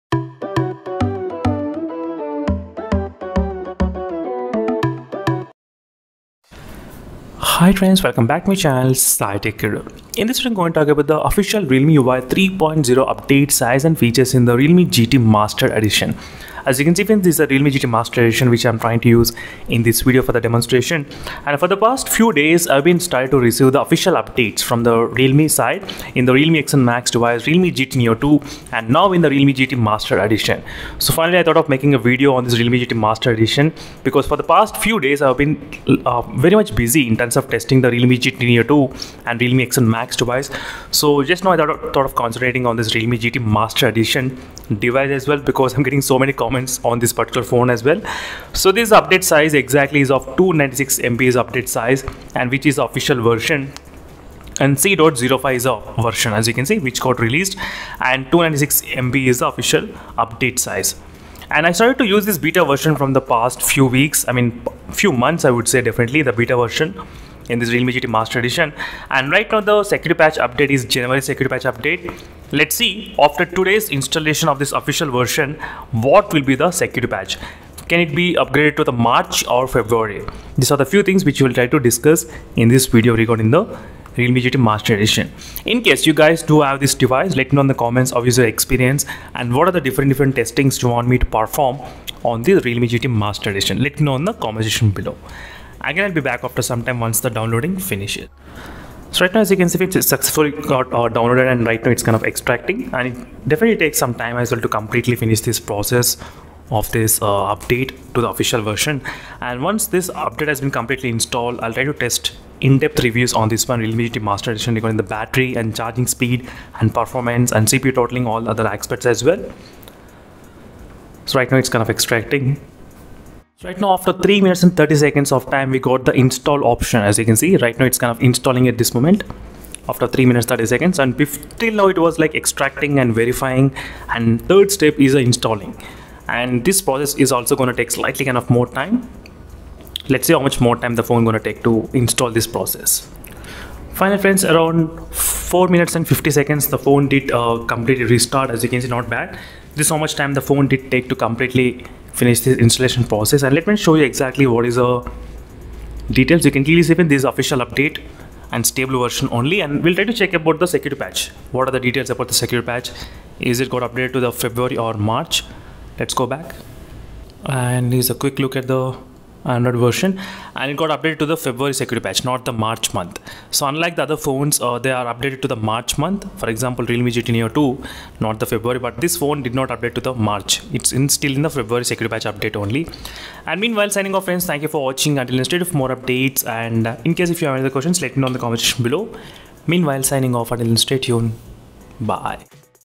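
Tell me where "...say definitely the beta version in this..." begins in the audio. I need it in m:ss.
1:05.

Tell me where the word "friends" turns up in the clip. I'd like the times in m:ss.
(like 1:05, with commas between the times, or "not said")
0:07, 2:24, 3:04.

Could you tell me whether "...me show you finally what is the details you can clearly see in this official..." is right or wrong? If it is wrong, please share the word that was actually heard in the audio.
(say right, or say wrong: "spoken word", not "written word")
wrong: "exactly", not "finally".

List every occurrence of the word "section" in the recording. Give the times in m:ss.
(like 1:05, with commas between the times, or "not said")
1:34, 3:08.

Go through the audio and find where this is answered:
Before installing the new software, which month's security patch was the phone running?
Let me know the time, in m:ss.
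1:10.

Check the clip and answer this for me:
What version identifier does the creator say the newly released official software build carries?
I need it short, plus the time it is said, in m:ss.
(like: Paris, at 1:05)
C.05, at 0:54.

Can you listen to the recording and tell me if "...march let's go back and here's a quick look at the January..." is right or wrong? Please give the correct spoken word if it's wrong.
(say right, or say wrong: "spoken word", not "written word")
wrong: "Android", not "January".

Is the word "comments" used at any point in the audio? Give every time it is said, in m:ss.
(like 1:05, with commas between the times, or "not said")
0:46, 1:27, 1:34, 3:08.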